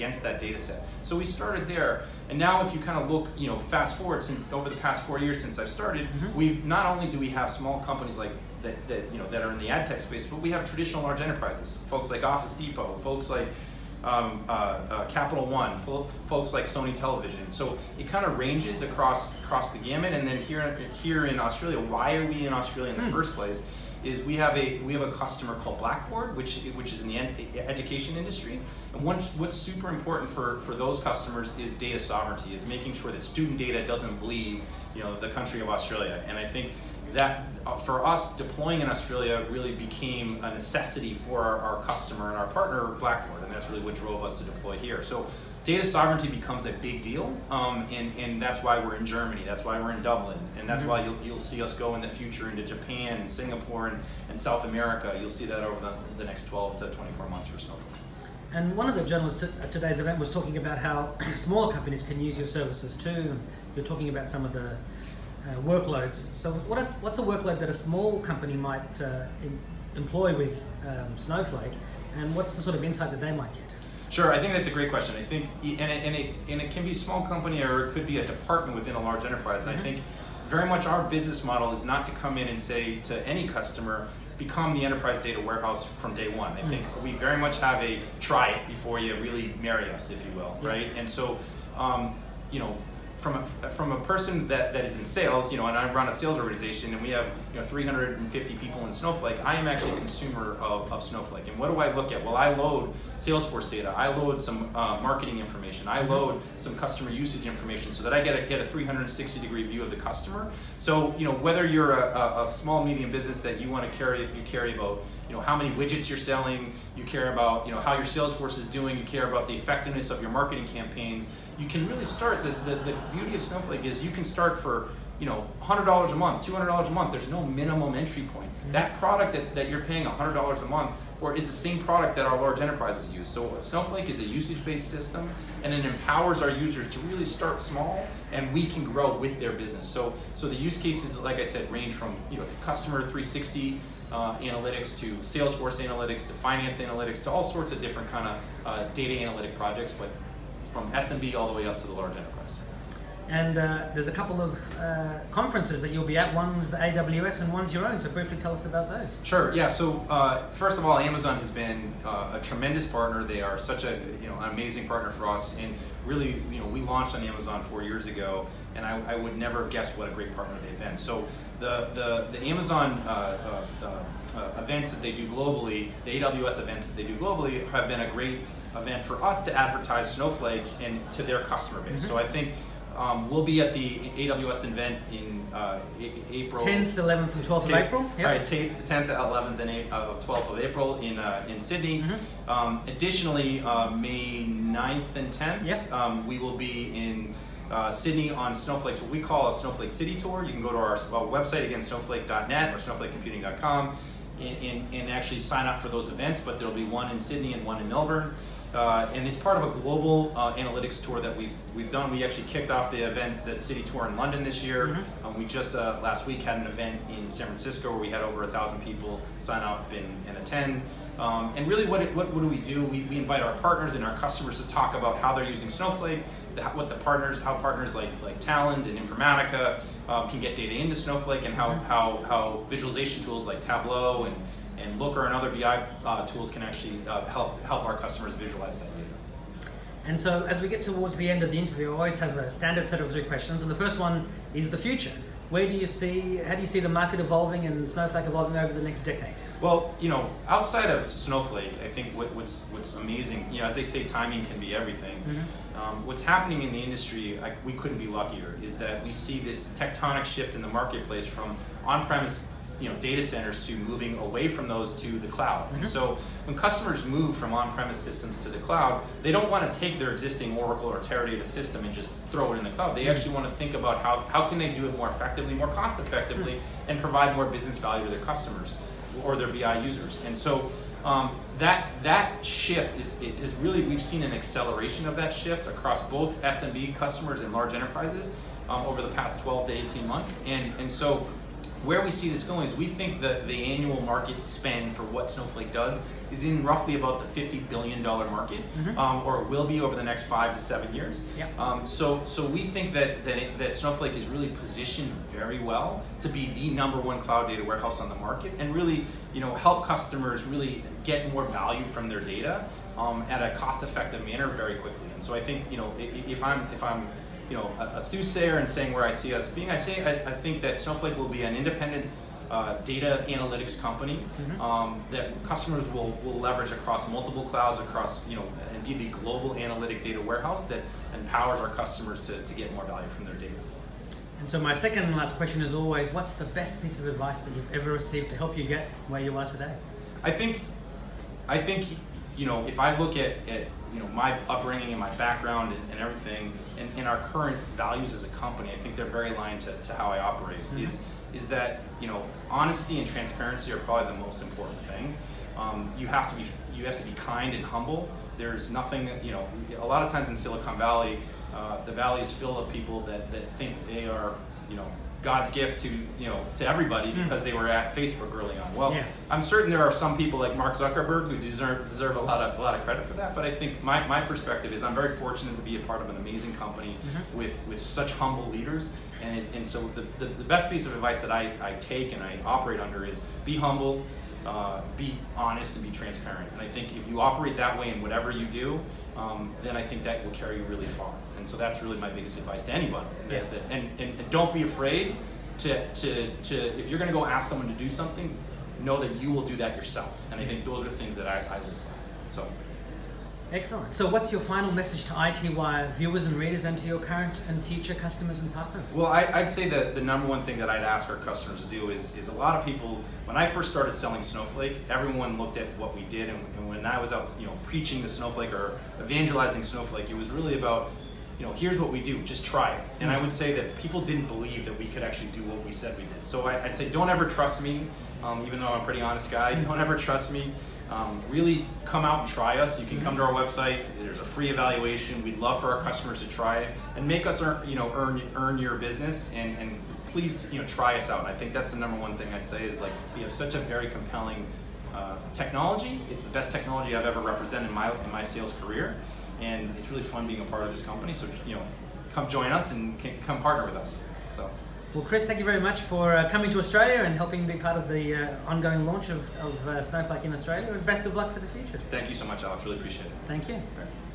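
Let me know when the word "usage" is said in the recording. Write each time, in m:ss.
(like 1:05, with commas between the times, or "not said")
1:47, 2:14.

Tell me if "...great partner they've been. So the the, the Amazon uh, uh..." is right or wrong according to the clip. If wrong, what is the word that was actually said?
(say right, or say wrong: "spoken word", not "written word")
right.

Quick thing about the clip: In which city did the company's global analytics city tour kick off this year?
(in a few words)
London.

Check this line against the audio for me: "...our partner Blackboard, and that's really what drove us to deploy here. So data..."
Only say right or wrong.
right.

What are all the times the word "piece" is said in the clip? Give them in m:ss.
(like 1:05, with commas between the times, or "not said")
5:36, 6:20.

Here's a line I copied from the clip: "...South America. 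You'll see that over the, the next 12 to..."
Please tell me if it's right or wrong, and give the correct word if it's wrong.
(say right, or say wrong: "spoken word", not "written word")
right.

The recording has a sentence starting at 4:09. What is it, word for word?
Well, you know, outside of Snowflake, I think what, what's what's amazing, you know, as they say, timing can be everything.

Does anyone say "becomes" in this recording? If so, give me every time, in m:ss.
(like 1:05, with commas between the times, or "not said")
0:46, 1:24.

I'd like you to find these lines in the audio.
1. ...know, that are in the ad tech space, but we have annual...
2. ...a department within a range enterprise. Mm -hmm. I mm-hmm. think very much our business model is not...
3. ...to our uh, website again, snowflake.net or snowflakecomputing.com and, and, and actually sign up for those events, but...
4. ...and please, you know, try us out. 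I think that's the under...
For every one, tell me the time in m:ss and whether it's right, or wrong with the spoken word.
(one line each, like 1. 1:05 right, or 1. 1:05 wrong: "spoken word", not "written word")
1. 0:09 wrong: "traditional", not "annual"
2. 1:18 wrong: "large", not "range"
3. 3:20 right
4. 7:19 wrong: "number", not "under".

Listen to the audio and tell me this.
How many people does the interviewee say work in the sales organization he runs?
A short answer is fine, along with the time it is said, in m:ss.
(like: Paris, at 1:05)
350, at 1:37.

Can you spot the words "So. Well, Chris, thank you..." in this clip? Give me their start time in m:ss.
7:34.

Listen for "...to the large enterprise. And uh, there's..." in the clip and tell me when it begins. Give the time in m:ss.
2:31.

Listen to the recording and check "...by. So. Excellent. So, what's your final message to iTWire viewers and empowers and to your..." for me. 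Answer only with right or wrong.
wrong.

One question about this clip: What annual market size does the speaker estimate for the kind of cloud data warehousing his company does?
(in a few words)
$50 billion.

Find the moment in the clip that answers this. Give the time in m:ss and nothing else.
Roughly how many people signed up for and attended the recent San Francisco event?
3:38.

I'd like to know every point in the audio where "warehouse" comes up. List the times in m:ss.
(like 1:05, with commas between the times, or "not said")
1:25, 5:07, 5:30.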